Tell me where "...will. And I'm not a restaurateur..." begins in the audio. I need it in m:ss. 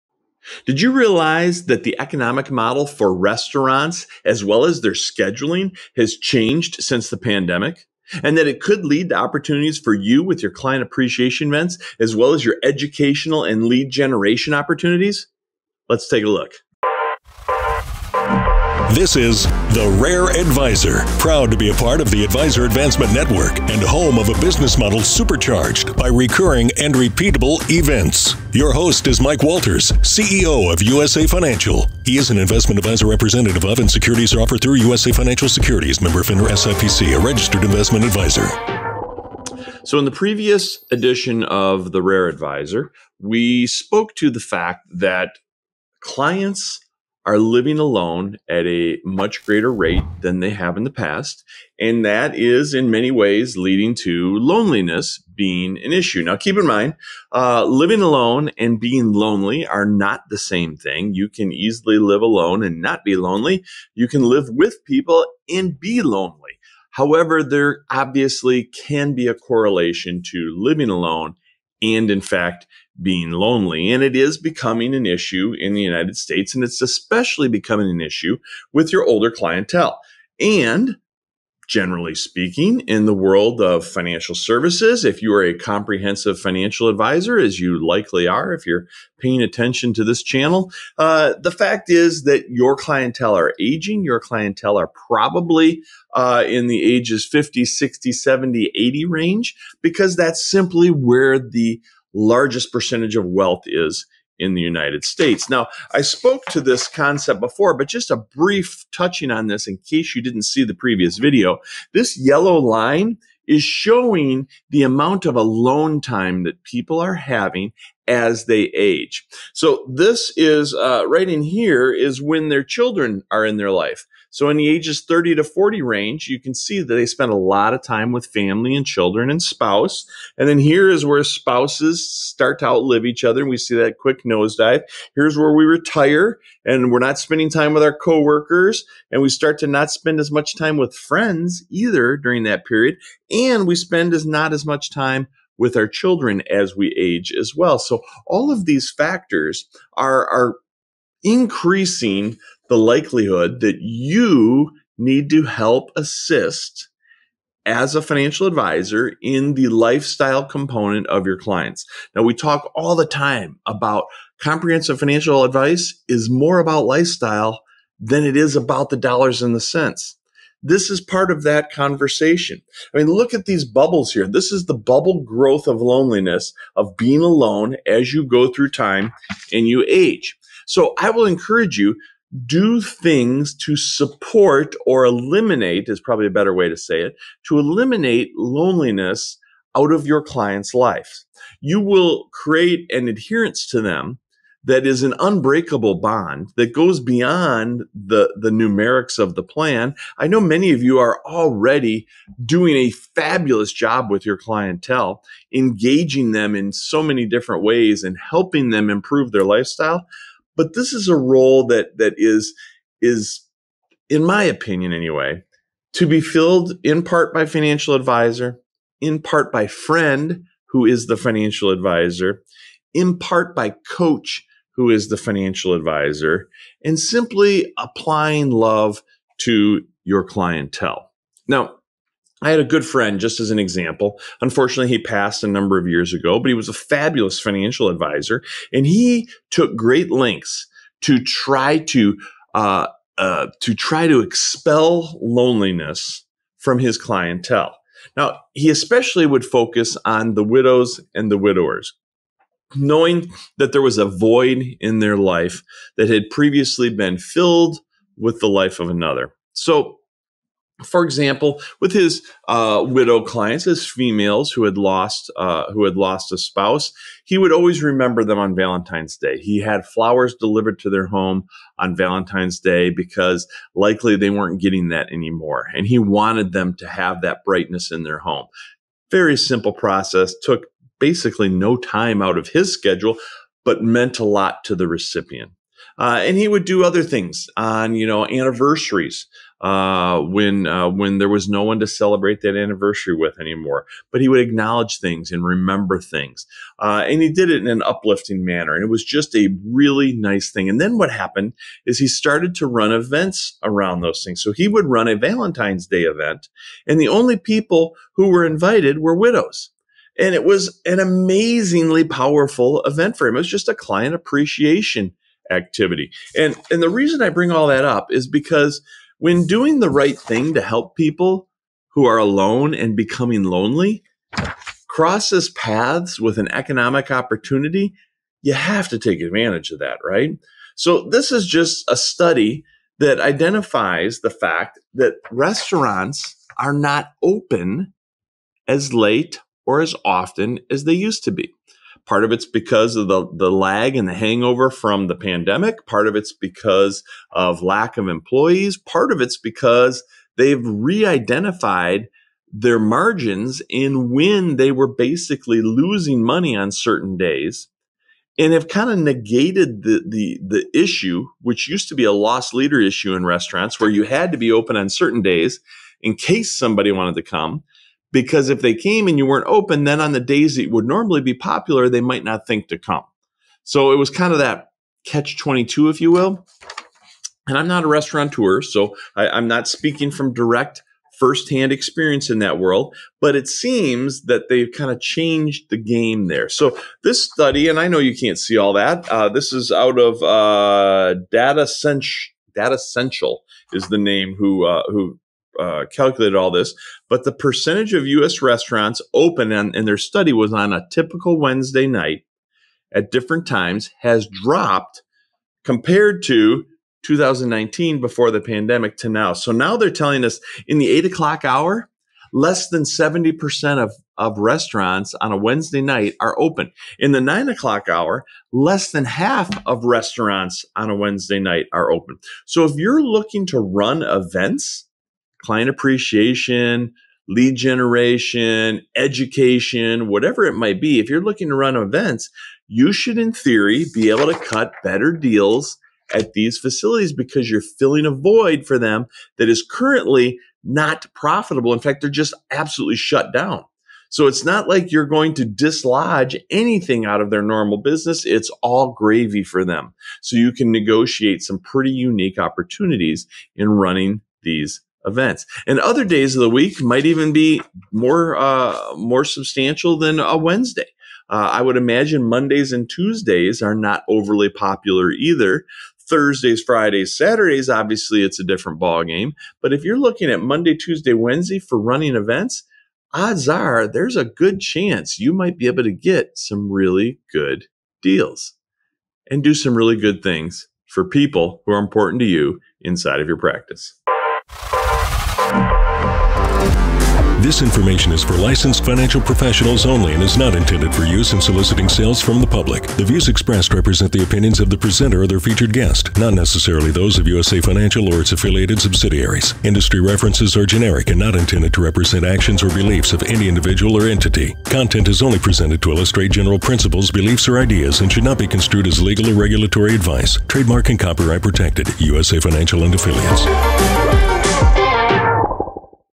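6:16.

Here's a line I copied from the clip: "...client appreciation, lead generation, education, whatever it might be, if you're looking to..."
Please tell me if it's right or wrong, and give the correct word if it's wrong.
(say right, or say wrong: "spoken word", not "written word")
right.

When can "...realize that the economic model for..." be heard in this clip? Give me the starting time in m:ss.
0:00.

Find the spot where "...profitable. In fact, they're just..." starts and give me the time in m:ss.
7:21.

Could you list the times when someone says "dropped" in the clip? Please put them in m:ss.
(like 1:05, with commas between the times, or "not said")
6:44.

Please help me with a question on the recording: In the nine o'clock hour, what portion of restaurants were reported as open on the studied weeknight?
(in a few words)
less than half.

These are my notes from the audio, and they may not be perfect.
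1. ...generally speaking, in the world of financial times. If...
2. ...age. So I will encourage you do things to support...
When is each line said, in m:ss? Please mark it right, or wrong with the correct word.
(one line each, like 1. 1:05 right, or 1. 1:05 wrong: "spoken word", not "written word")
1. 1:21 wrong: "services", not "times"
2. 2:59 right.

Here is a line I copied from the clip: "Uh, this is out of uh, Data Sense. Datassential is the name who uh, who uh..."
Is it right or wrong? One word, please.
right.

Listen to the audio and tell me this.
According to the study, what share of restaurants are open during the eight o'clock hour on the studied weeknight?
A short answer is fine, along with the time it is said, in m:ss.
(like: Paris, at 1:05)
less than 70%, at 6:52.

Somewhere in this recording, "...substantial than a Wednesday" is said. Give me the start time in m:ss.
7:39.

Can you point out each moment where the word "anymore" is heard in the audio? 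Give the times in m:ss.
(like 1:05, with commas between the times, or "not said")
4:35, 4:53.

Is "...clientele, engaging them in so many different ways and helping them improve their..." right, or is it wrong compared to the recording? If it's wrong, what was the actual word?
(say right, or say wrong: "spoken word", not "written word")
right.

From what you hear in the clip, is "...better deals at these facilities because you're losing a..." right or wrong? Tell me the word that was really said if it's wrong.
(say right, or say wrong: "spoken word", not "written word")
wrong: "filling", not "losing".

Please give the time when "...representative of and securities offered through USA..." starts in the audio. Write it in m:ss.
0:33.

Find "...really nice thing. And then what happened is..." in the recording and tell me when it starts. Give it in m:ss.
4:59.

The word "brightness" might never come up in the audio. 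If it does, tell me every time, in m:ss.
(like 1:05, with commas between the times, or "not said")
4:37.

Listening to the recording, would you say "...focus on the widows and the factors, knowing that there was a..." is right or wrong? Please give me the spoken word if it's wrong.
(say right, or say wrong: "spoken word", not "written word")
wrong: "widowers", not "factors".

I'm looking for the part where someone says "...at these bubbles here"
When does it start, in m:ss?
2:53.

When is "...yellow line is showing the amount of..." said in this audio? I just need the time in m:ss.
1:52.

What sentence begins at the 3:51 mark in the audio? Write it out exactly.
Now, I had a good friend, just as an example.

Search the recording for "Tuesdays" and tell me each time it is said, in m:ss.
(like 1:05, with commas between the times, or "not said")
7:42, 7:50.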